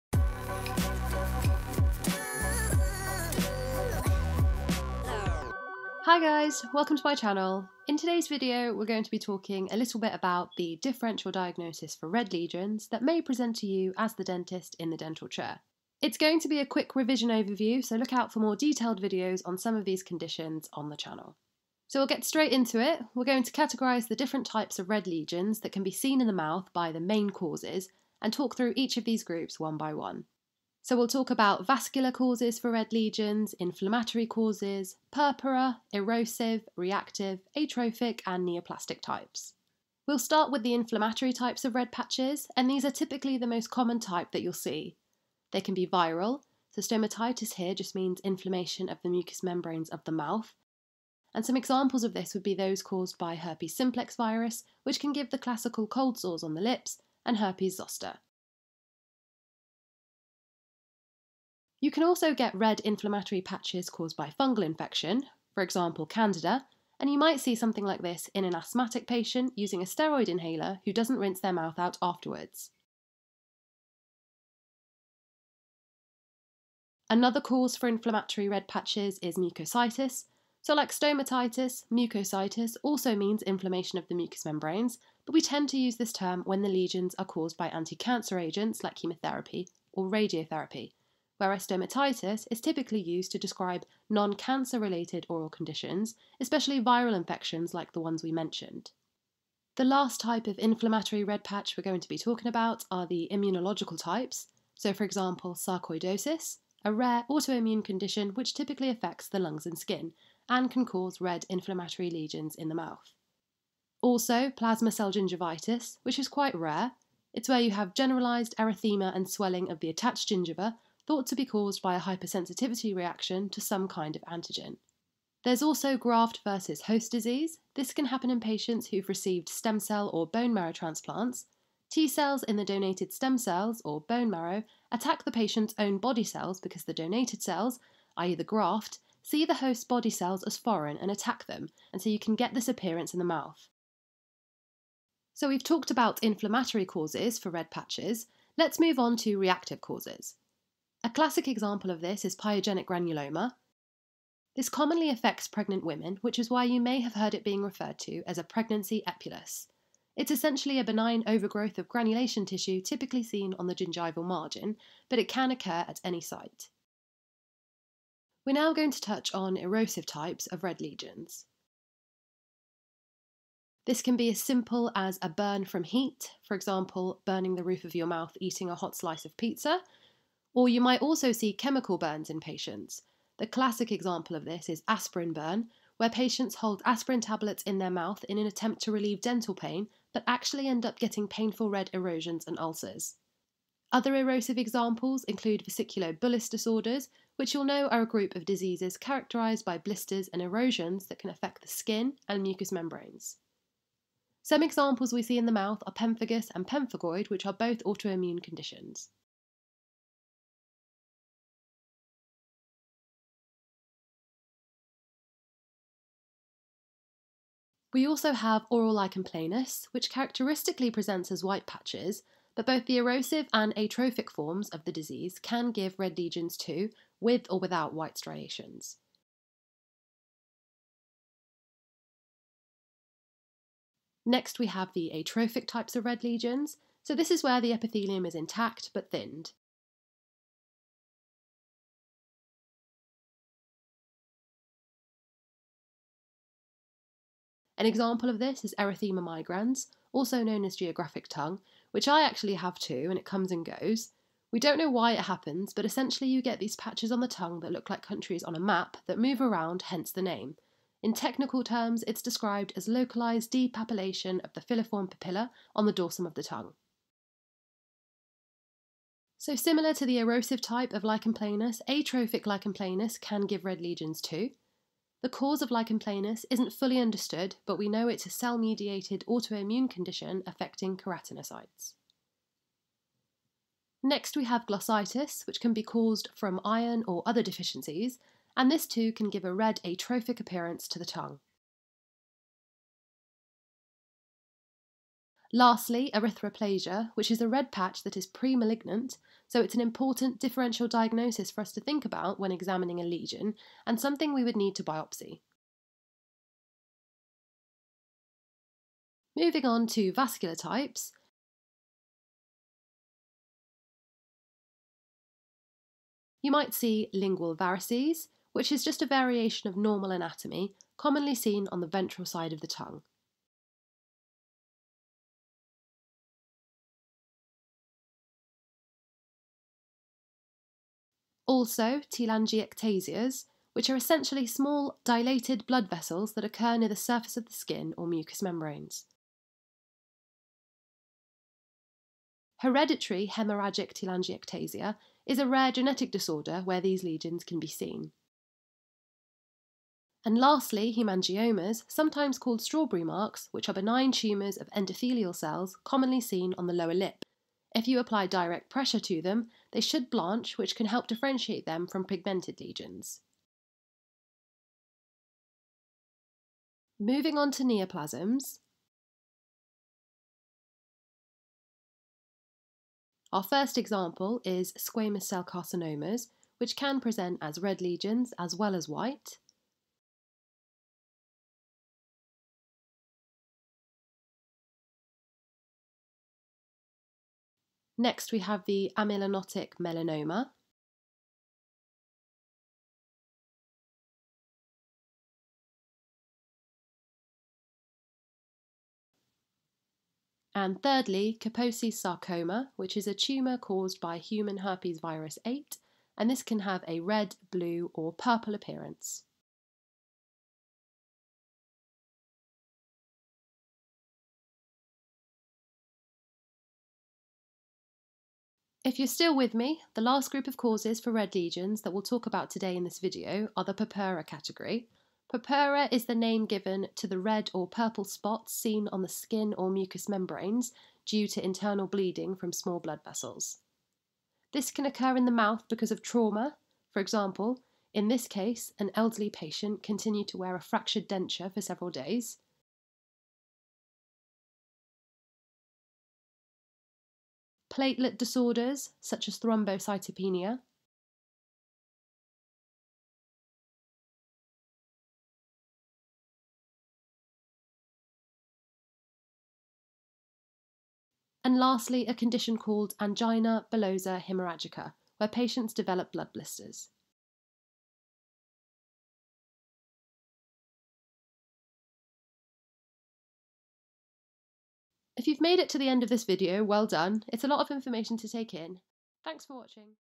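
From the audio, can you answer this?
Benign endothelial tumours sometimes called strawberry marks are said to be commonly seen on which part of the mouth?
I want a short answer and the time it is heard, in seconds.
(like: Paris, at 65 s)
Lower lip, at 356 s.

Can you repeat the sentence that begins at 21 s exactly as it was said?
So we'll get straight into it.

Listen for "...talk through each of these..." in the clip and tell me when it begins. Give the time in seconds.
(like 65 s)
28 s.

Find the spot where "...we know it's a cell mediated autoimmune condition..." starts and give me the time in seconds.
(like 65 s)
277 s.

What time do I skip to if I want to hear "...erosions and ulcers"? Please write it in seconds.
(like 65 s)
191 s.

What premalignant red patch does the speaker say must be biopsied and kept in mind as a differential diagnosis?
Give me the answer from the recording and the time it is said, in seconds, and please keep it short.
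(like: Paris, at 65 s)
Erythroplasia, at 296 s.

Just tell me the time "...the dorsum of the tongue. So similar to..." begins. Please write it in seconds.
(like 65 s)
265 s.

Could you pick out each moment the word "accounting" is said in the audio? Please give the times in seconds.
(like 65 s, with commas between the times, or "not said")
not said.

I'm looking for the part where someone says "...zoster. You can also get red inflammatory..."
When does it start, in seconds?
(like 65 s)
57 s.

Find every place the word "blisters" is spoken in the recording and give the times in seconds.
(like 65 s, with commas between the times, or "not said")
199 s, 466 s.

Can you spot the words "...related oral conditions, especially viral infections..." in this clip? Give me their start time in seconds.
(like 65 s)
94 s.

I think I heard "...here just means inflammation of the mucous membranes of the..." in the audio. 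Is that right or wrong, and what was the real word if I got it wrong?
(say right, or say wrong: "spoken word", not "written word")
right.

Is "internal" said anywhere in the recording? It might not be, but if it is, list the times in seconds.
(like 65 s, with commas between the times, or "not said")
431 s.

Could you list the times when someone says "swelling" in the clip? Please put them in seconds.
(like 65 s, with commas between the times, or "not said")
119 s.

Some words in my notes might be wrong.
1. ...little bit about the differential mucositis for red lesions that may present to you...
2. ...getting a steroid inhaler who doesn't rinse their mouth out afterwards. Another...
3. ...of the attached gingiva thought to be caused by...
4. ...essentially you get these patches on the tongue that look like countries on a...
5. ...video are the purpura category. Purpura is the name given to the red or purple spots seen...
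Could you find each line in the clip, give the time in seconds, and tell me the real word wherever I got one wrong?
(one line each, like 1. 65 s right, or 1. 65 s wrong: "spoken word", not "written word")
1. 9 s wrong: "diagnosis", not "mucositis"
2. 69 s wrong: "using", not "getting"
3. 119 s right
4. 255 s right
5. 422 s right.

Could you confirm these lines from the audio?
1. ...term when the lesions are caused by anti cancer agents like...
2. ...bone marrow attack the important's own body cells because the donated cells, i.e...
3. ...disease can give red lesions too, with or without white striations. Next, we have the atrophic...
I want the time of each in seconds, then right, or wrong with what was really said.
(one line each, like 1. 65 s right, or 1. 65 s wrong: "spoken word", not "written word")
1. 86 s right
2. 134 s wrong: "patient", not "important"
3. 224 s right.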